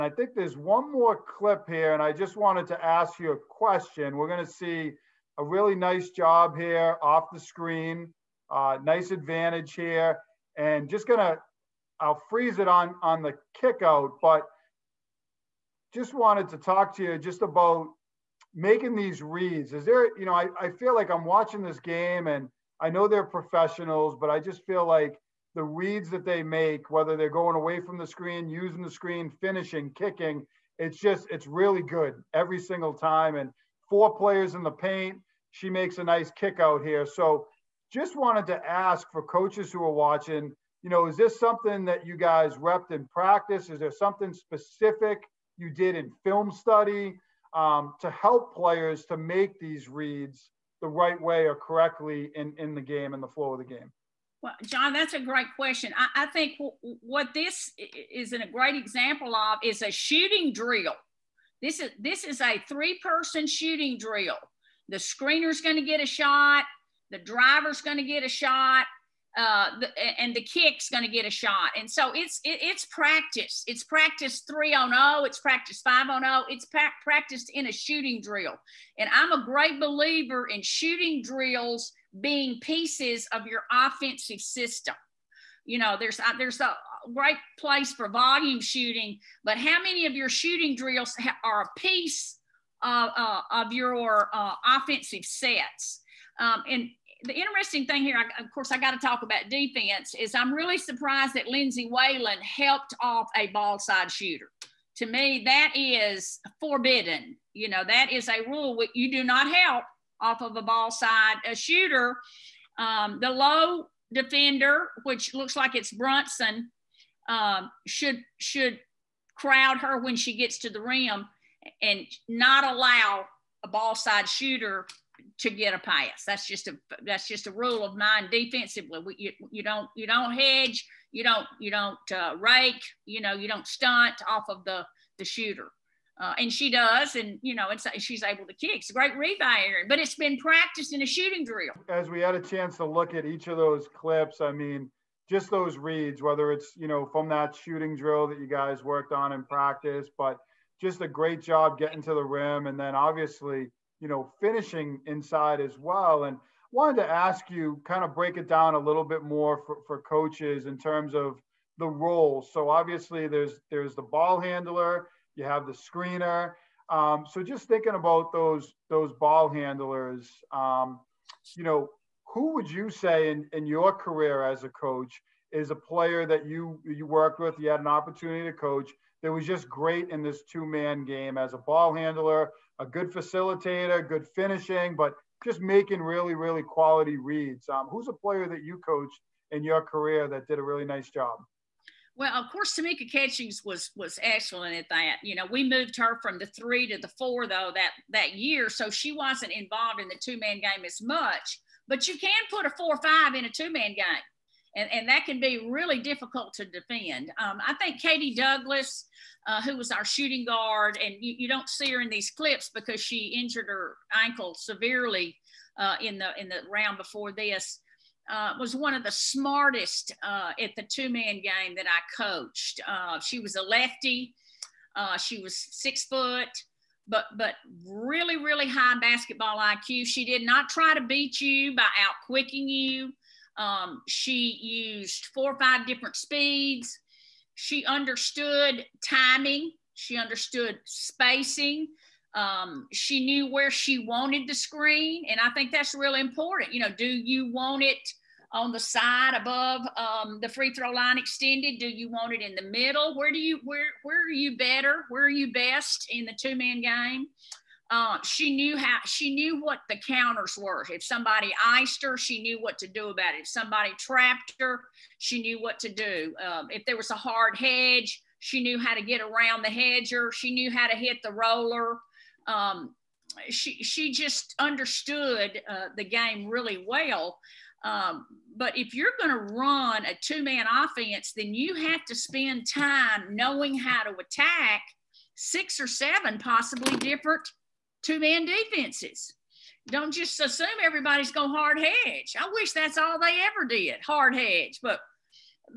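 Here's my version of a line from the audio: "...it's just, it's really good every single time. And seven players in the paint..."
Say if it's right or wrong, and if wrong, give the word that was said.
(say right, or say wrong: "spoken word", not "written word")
wrong: "four", not "seven".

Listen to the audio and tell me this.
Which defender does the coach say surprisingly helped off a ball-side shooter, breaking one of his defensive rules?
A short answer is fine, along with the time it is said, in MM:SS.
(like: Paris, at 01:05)
Lindsay Whalen, at 01:41.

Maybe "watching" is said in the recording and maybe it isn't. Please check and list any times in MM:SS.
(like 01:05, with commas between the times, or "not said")
00:21, 00:39.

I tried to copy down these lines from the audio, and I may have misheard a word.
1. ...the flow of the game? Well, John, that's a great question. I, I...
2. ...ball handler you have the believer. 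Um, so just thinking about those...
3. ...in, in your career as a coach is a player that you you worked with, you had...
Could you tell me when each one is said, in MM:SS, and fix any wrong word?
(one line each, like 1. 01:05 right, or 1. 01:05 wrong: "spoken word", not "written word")
1. 00:53 right
2. 02:44 wrong: "screener", not "believer"
3. 02:53 right.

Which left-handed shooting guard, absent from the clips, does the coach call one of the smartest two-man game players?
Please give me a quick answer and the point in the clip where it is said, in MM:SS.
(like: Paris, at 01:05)
Katie Douglas, at 03:28.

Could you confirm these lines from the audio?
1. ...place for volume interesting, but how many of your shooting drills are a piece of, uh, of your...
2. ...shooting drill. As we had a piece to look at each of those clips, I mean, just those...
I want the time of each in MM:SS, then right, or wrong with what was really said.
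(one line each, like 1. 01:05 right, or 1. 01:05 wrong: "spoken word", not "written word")
1. 01:27 wrong: "shooting", not "interesting"
2. 02:21 wrong: "chance", not "piece".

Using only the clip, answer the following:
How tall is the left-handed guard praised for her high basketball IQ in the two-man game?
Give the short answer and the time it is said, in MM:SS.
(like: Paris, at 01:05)
6 feet, at 03:45.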